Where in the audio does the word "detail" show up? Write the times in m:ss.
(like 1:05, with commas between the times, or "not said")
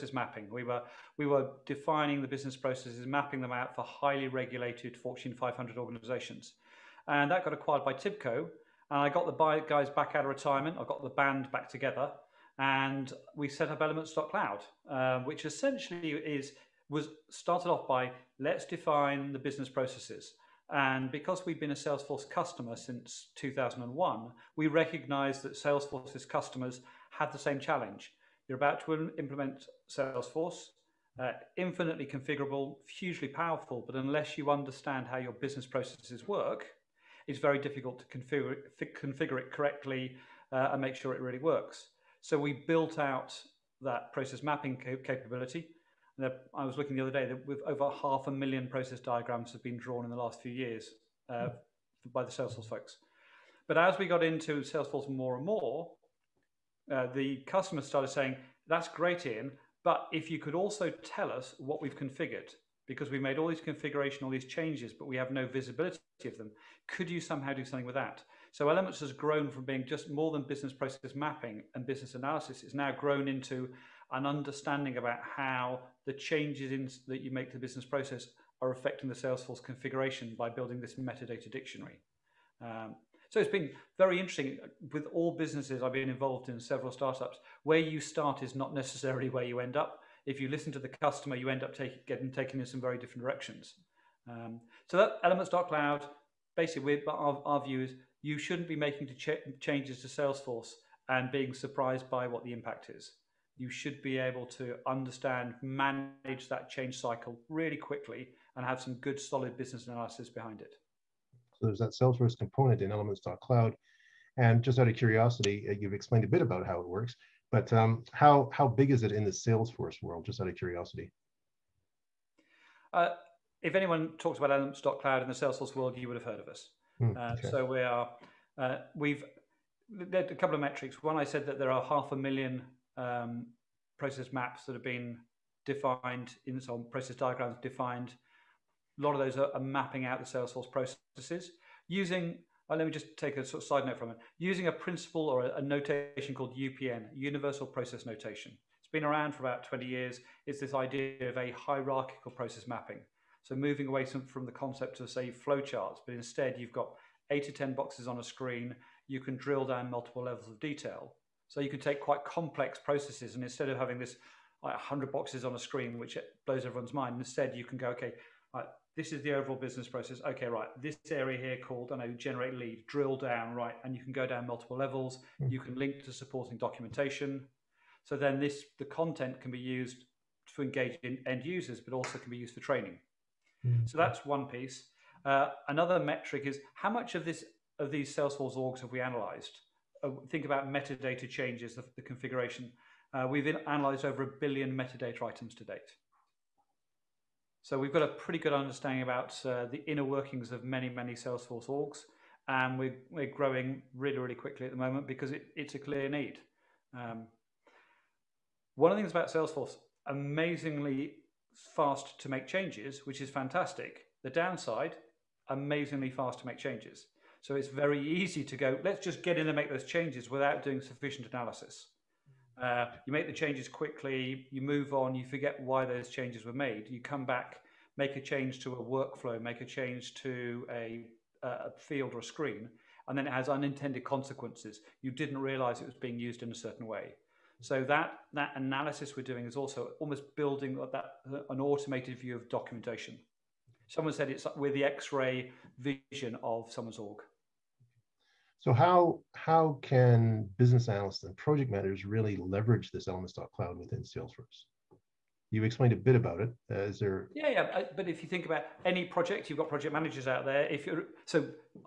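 2:40.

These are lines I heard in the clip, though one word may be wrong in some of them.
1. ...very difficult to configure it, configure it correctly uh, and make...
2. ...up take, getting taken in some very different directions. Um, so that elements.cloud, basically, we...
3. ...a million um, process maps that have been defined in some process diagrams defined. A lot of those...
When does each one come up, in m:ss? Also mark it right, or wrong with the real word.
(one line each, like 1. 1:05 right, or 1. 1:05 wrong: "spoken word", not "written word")
1. 0:37 right
2. 1:31 right
3. 2:12 right.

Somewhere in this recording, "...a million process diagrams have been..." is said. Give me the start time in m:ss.
0:48.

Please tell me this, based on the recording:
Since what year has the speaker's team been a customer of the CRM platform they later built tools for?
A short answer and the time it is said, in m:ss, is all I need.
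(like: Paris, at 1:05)
2001, at 0:23.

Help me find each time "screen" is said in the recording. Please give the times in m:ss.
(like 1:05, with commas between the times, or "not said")
2:38, 2:45, 3:52.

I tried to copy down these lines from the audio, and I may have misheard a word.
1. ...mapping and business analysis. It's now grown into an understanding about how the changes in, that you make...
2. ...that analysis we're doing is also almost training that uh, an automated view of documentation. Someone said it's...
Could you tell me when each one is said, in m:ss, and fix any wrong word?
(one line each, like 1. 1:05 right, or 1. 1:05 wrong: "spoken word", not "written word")
1. 1:11 right
2. 3:58 wrong: "building", not "training".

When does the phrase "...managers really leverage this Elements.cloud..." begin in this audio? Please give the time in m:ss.
4:11.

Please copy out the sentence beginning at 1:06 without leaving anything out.
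Could you somehow do something with that?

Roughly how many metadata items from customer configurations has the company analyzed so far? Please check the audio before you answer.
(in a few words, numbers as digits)
over a billion.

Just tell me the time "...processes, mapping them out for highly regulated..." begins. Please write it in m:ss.
0:02.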